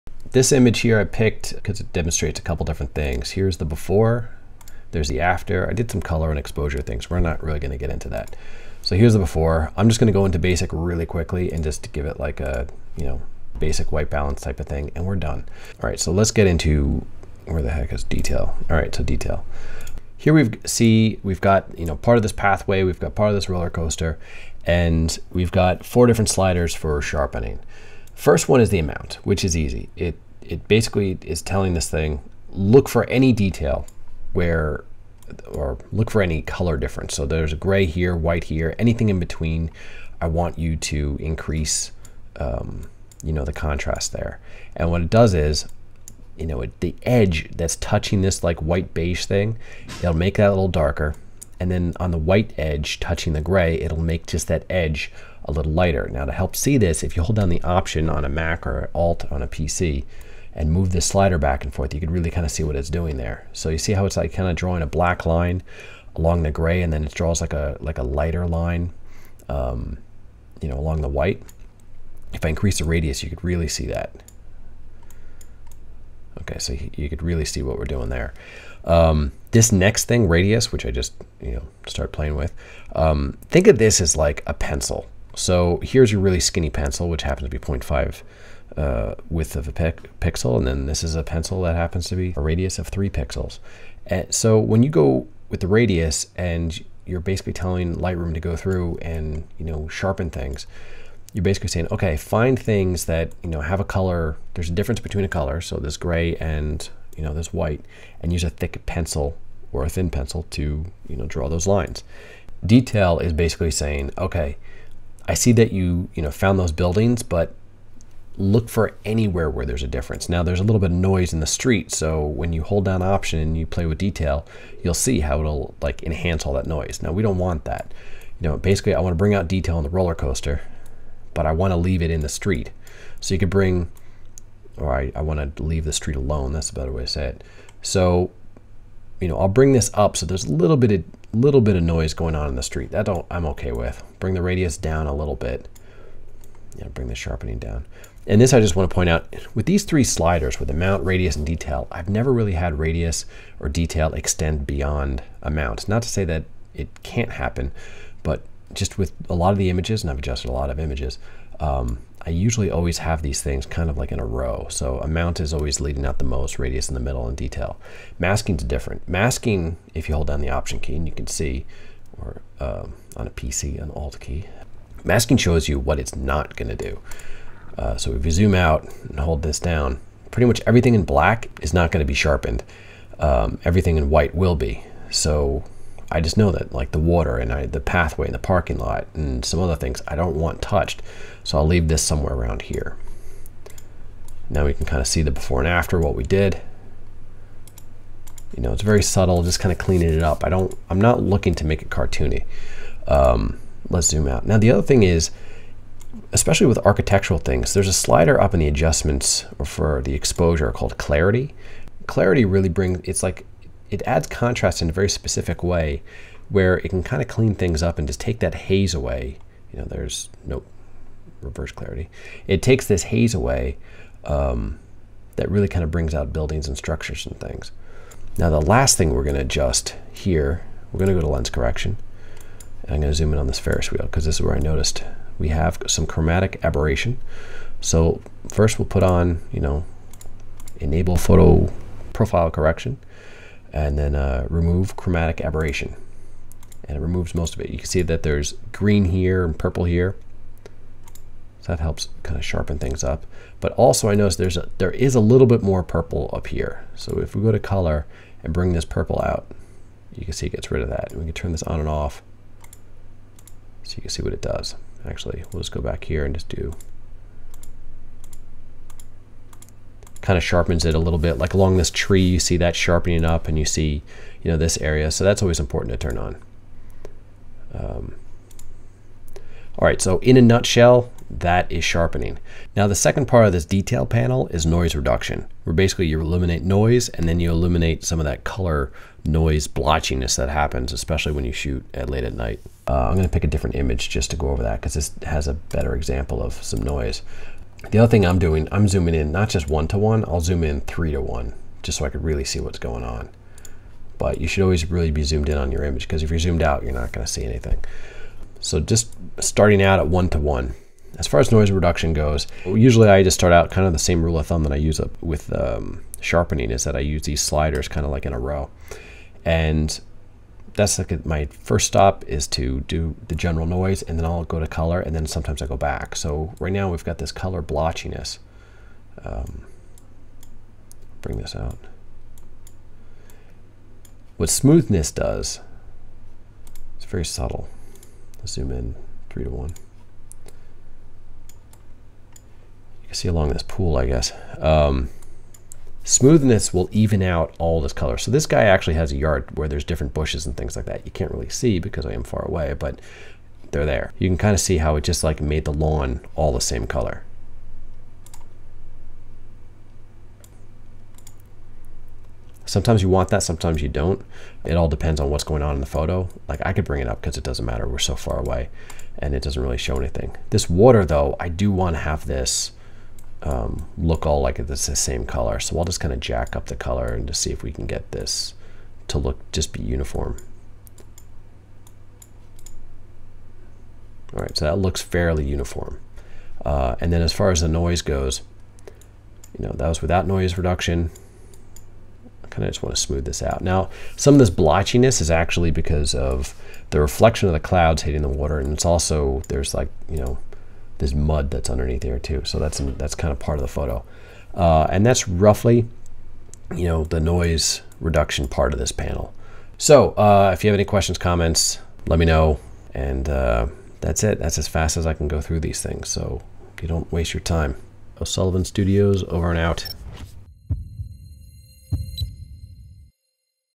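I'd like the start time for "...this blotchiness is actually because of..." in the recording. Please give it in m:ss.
6:34.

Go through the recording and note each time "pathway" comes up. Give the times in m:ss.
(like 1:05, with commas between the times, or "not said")
0:22, 3:07.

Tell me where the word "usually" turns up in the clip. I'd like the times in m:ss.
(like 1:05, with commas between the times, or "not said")
2:42, 5:12.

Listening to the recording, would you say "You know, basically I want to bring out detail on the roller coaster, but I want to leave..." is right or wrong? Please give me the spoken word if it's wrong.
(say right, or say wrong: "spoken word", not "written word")
right.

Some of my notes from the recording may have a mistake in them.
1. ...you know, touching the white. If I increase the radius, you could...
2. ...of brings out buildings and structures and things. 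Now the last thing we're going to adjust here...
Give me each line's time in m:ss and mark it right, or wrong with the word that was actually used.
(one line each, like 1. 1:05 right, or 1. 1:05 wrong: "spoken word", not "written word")
1. 1:10 wrong: "along", not "touching"
2. 3:45 right.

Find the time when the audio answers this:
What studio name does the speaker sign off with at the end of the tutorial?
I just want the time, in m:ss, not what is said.
6:58.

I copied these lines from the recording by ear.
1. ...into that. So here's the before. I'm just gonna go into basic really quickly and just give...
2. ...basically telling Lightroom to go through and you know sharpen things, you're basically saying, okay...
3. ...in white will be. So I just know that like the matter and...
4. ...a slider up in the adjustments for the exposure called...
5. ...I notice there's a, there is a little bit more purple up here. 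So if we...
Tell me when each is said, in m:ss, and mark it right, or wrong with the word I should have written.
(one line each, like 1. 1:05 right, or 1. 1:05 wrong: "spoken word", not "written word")
1. 0:07 right
2. 1:37 right
3. 3:03 wrong: "water", not "matter"
4. 3:27 right
5. 4:14 right.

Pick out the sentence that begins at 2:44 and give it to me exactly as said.
So amount is always leading out the most, radius in the middle, and detail.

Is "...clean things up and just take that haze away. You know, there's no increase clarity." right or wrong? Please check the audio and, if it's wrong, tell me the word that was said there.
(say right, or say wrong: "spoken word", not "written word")
wrong: "reverse", not "increase".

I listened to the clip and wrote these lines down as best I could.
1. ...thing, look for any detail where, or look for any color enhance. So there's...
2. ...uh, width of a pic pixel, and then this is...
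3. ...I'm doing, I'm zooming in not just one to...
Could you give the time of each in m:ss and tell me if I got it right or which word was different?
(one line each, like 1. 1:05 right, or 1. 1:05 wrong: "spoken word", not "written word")
1. 0:31 wrong: "difference", not "enhance"
2. 1:28 right
3. 4:58 right.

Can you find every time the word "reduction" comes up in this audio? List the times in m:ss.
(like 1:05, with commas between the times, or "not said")
4:44, 5:11, 6:30, 6:47.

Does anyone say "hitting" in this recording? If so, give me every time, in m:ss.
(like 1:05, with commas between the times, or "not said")
6:38.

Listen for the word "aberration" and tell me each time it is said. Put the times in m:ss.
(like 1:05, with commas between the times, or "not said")
3:56, 4:05.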